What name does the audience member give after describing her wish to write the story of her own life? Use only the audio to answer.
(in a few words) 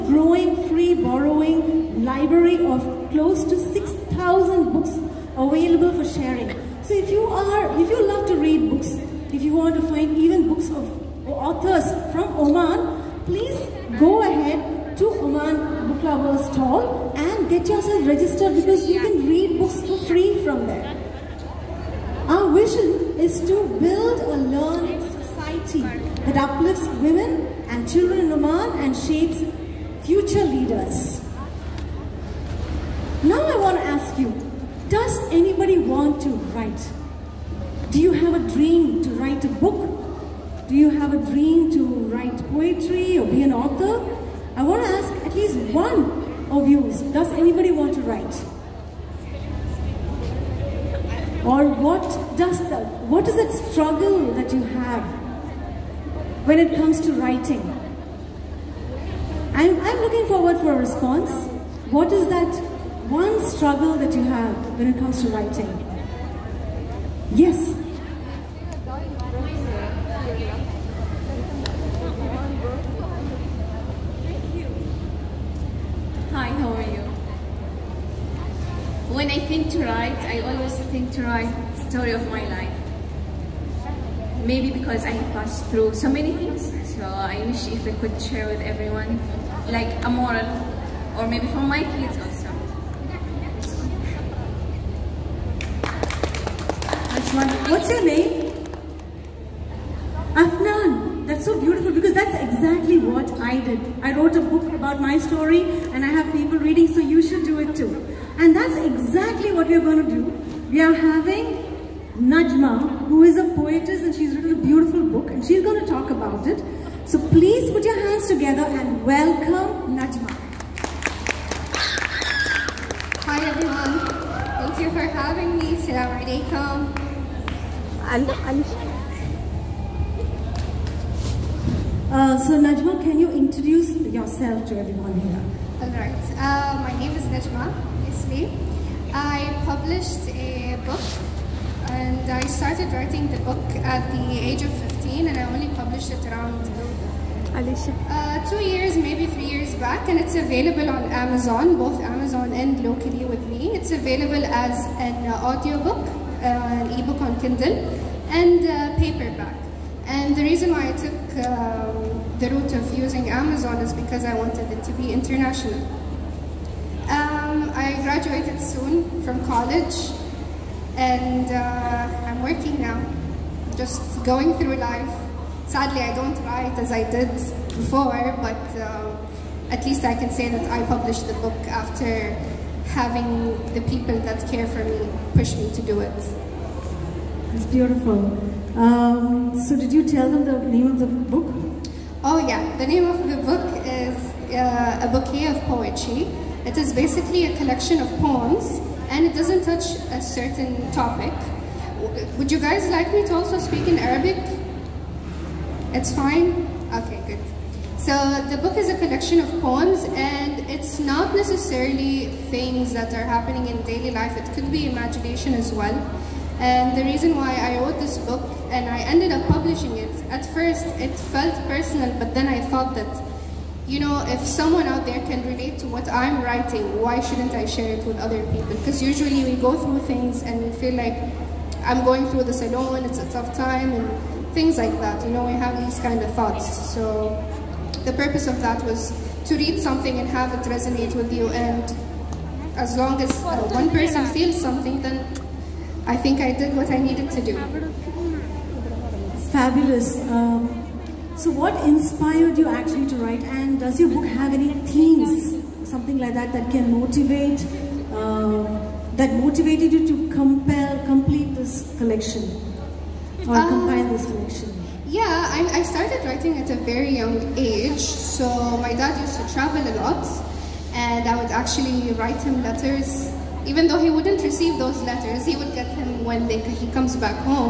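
Afnan.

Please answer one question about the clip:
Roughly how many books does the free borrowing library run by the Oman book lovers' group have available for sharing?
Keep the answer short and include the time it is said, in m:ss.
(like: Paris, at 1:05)
6,000, at 0:03.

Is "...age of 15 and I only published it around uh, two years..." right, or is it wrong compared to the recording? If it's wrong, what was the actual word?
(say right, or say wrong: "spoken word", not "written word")
right.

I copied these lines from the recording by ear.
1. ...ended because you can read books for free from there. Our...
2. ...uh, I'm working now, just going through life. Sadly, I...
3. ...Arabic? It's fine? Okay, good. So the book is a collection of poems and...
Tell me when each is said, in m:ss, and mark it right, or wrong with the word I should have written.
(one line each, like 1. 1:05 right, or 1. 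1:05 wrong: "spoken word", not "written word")
1. 0:18 wrong: "registered", not "ended"
2. 2:51 right
3. 3:23 right.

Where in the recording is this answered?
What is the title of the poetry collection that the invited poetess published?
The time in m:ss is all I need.
3:15.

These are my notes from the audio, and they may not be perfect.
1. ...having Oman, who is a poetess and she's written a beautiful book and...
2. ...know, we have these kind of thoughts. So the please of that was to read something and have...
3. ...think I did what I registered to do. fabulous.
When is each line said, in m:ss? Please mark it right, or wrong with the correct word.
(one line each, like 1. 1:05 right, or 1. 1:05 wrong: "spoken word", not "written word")
1. 1:50 wrong: "Najma", not "Oman"
2. 3:55 wrong: "purpose", not "please"
3. 4:06 wrong: "needed", not "registered".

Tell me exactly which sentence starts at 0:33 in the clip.
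Now I want to ask you, does anybody want to write?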